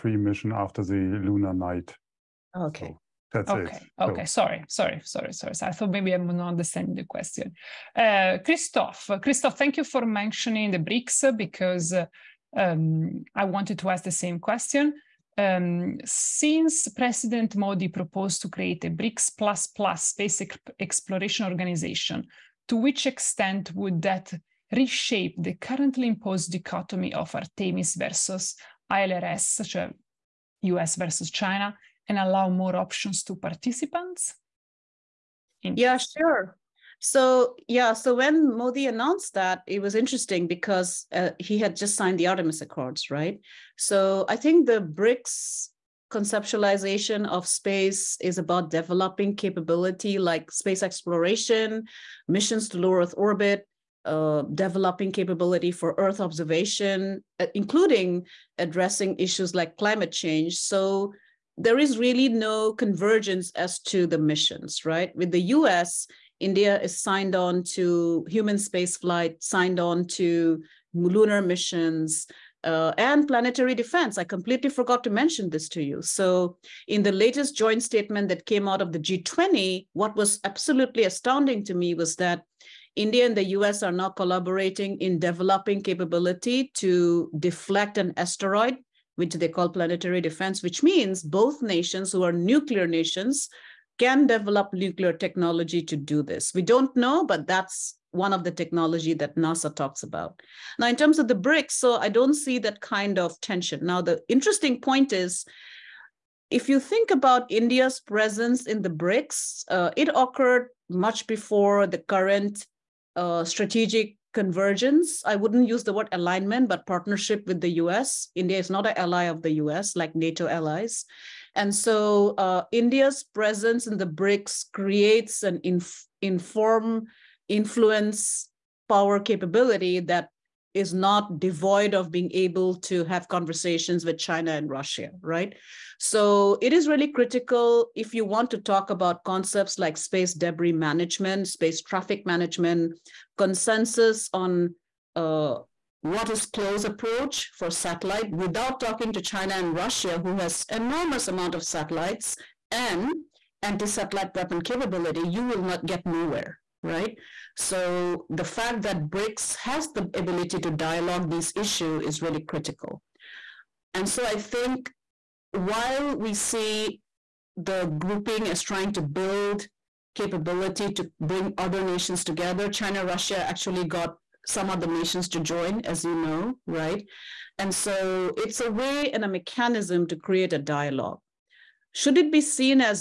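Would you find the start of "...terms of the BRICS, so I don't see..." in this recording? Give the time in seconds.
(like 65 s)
100 s.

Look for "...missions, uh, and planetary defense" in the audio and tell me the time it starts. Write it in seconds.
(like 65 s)
71 s.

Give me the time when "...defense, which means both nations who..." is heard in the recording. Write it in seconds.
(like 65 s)
90 s.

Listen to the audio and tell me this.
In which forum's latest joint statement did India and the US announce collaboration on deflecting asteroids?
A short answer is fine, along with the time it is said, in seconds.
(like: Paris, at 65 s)
G20, at 78 s.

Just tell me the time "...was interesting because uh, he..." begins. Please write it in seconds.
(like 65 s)
39 s.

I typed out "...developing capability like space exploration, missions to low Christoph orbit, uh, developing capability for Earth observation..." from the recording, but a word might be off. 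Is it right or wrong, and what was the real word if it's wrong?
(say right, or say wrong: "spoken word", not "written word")
wrong: "Earth", not "Christoph".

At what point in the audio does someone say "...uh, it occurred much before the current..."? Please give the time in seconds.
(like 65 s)
109 s.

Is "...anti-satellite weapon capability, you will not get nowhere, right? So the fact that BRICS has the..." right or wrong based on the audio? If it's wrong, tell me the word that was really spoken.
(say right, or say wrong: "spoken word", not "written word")
right.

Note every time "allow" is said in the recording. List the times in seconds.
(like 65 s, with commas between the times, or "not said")
32 s.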